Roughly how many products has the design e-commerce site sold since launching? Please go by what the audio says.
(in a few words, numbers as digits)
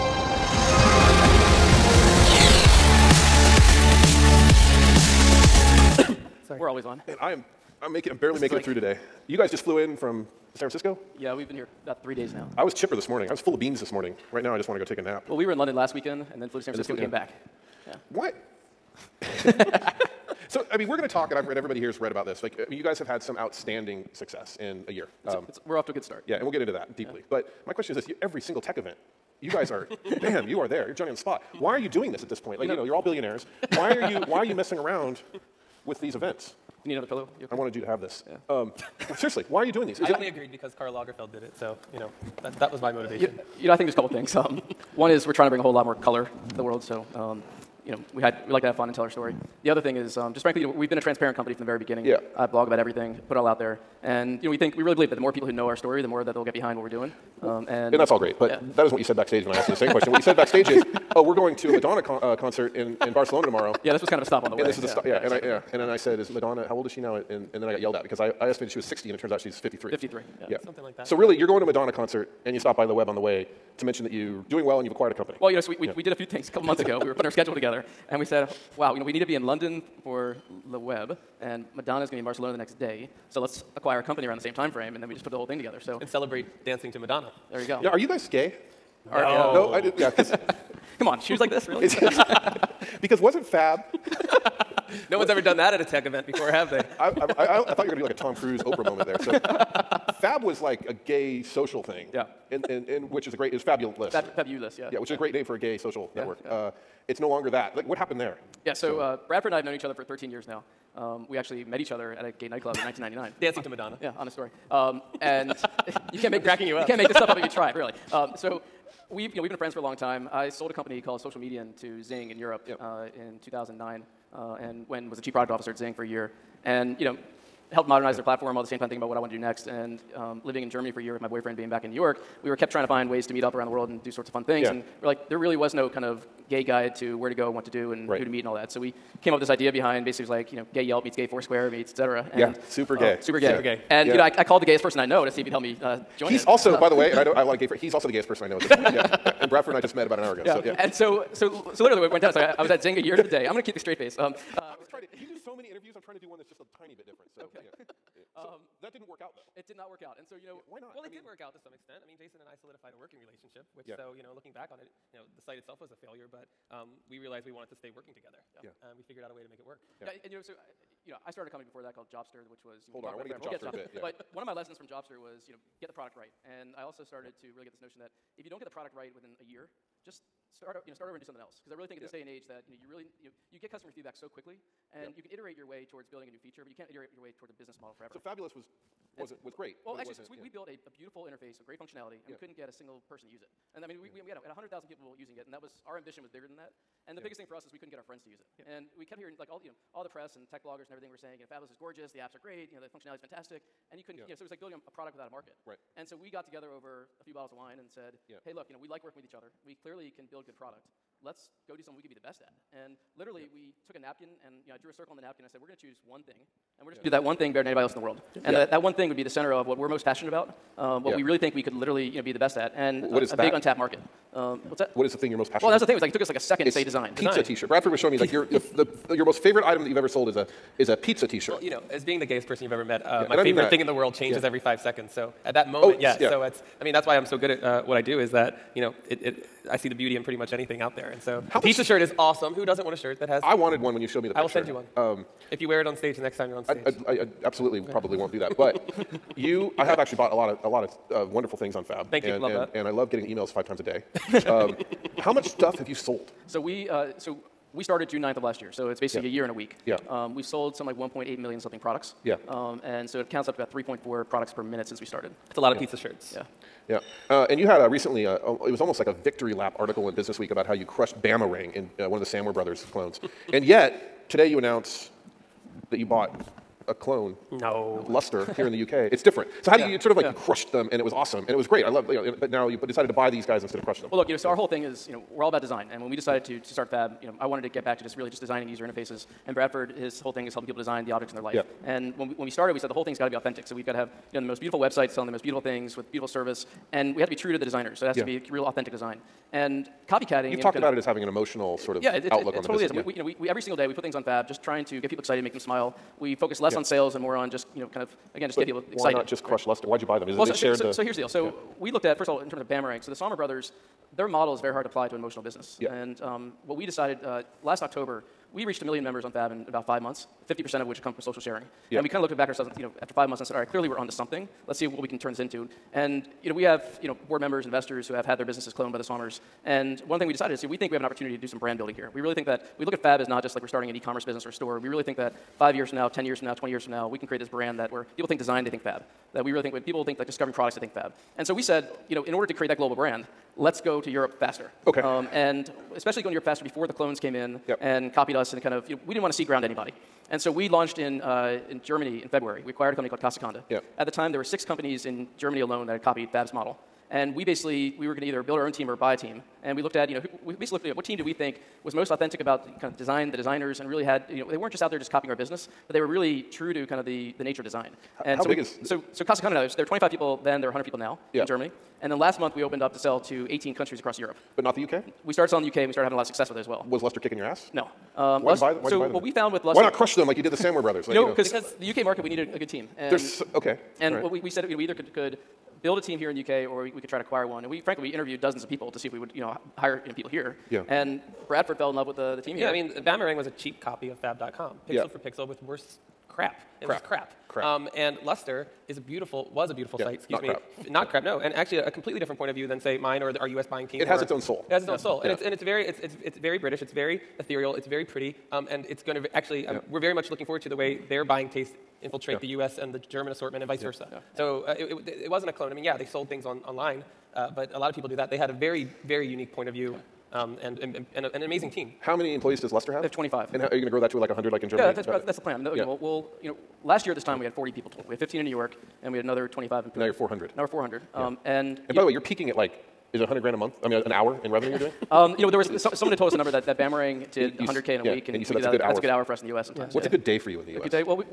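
1.8 million.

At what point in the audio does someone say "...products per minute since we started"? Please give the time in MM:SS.
04:24.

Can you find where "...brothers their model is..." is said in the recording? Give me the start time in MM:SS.
05:13.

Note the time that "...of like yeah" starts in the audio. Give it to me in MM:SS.
04:40.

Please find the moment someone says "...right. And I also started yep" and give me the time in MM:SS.
02:56.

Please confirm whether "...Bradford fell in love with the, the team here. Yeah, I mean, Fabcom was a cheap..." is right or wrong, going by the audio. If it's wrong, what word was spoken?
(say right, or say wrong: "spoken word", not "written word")
wrong: "Bamarang", not "Fabcom".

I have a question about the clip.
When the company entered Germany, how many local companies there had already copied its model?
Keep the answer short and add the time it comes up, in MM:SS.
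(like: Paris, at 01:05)
6, at 05:54.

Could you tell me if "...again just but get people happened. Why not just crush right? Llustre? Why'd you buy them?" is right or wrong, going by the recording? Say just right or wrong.
wrong.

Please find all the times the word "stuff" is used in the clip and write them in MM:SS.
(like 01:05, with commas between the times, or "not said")
01:57, 04:15.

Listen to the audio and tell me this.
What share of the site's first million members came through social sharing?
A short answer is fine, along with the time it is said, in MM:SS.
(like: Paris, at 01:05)
50%, at 05:20.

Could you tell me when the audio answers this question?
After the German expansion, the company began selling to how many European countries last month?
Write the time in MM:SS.
06:13.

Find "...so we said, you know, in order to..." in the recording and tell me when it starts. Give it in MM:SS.
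05:41.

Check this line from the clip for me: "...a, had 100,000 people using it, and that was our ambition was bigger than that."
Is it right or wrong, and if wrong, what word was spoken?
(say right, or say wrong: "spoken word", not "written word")
right.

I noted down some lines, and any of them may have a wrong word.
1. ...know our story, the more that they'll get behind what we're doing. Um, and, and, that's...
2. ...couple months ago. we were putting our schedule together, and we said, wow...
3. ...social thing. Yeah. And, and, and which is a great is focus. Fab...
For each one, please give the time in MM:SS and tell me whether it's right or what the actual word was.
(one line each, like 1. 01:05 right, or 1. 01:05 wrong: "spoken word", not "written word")
1. 00:55 right
2. 01:16 right
3. 01:41 wrong: "fabulous", not "focus".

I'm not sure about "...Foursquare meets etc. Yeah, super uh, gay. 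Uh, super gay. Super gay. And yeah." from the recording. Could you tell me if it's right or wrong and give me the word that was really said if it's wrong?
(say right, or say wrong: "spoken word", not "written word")
right.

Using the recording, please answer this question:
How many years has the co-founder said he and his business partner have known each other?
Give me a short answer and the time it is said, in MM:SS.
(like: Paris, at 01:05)
13 years, at 01:50.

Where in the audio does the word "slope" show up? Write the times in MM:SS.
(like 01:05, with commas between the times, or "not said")
not said.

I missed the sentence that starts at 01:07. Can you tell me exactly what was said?
And and then I got yelled at because I, I estimated she was 60, and it turns out she's 53.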